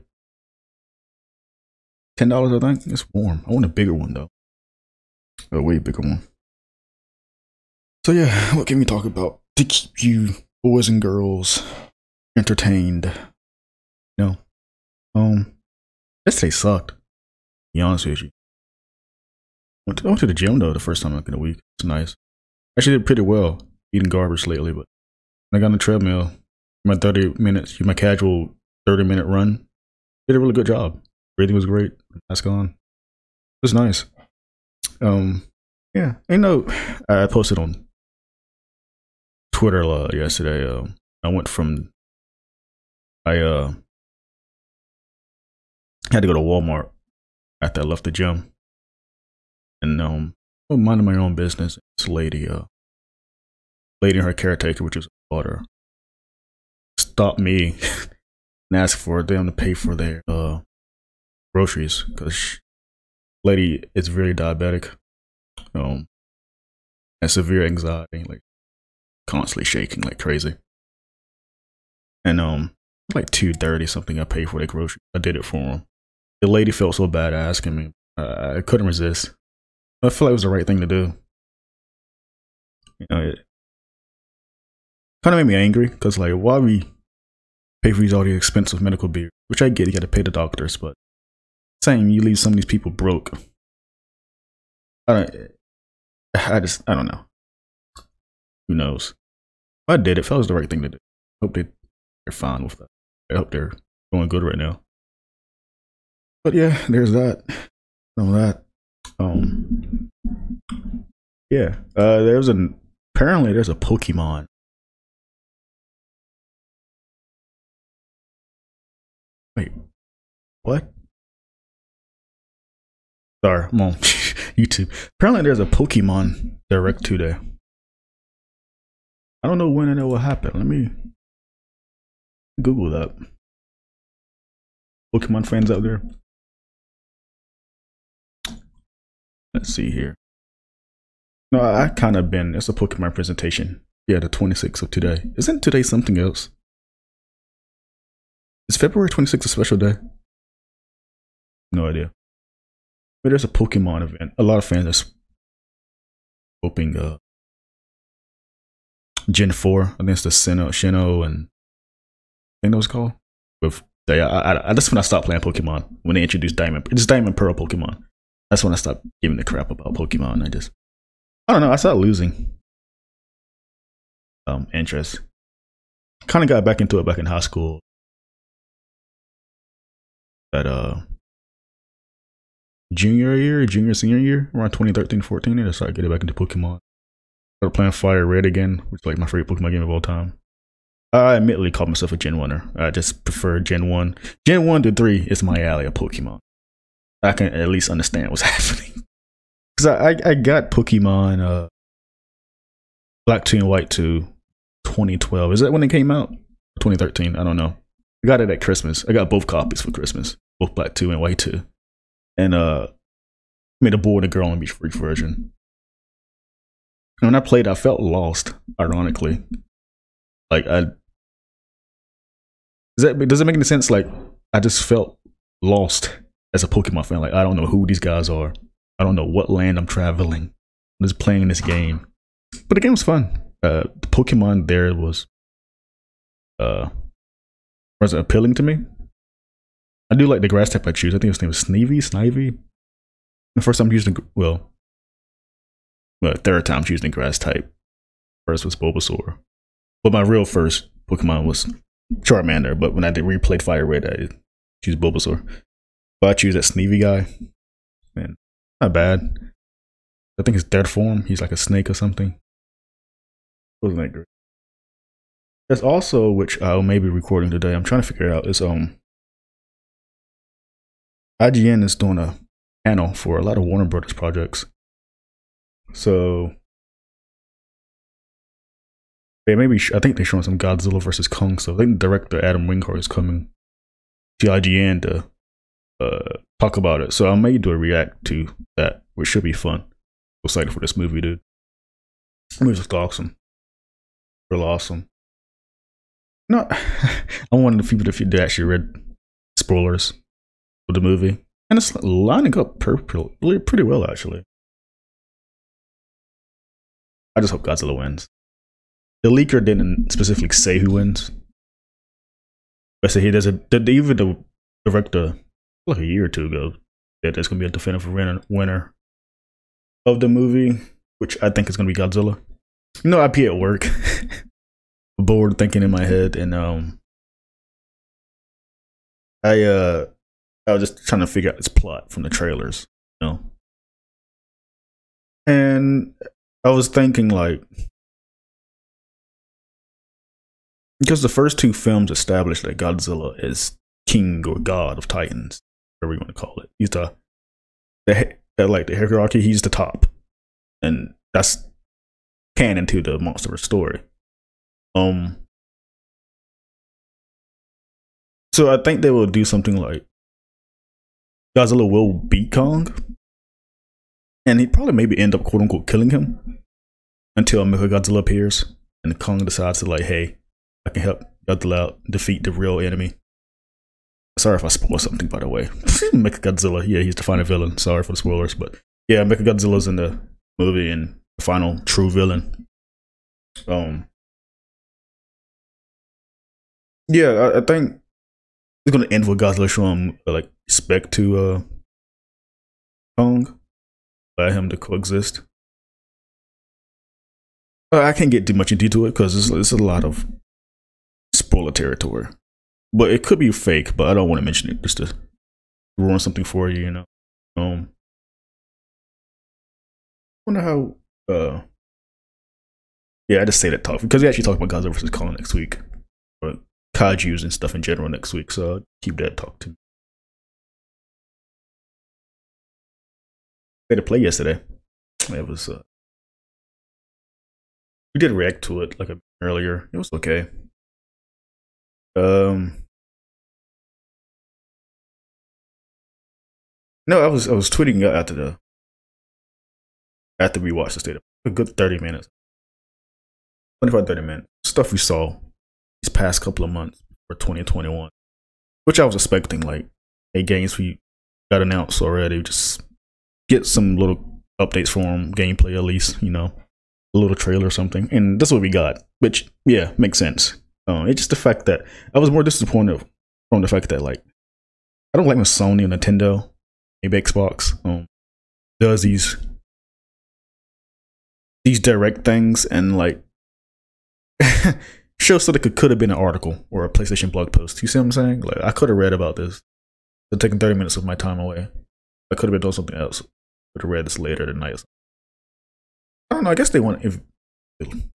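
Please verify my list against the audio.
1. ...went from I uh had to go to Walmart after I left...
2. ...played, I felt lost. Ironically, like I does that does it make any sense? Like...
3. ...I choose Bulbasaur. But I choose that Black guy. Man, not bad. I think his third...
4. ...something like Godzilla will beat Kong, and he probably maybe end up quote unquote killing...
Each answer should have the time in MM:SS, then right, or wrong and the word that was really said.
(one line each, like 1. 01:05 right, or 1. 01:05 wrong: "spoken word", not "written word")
1. 00:41 right
2. 03:37 right
3. 04:14 wrong: "Sneevy", not "Black"
4. 05:59 right.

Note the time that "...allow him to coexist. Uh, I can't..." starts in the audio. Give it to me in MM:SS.
06:34.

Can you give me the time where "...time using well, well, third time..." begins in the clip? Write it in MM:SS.
04:03.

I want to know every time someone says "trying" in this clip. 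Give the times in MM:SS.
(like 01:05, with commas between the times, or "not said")
04:27, 05:31.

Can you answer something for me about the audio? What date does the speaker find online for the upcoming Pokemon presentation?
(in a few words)
February 26th.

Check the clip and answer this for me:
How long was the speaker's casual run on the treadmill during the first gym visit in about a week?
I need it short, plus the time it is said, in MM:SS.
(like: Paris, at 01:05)
30 minutes, at 00:28.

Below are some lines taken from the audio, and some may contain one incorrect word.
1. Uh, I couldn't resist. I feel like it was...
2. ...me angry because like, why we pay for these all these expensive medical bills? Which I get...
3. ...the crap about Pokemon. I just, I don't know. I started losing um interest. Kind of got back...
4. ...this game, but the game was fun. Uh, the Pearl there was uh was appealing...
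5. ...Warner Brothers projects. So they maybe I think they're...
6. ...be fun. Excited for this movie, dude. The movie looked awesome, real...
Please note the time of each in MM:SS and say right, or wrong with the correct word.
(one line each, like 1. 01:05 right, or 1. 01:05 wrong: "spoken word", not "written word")
1. 01:18 right
2. 01:25 right
3. 02:49 right
4. 03:51 wrong: "Pokemon", not "Pearl"
5. 04:33 right
6. 04:49 right.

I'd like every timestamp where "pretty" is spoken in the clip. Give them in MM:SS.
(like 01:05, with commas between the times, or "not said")
00:23, 05:02.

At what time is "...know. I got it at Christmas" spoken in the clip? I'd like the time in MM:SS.
03:27.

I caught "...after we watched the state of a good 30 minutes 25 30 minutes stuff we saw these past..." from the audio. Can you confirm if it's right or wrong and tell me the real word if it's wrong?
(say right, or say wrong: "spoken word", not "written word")
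right.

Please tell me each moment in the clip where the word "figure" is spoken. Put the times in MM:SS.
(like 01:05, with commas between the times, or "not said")
04:28, 05:31.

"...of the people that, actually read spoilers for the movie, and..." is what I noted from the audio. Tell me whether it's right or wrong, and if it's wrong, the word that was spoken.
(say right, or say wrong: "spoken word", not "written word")
right.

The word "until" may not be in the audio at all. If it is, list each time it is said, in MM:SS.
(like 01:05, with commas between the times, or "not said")
06:07.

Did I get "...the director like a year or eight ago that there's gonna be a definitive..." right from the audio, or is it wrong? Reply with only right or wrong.
wrong.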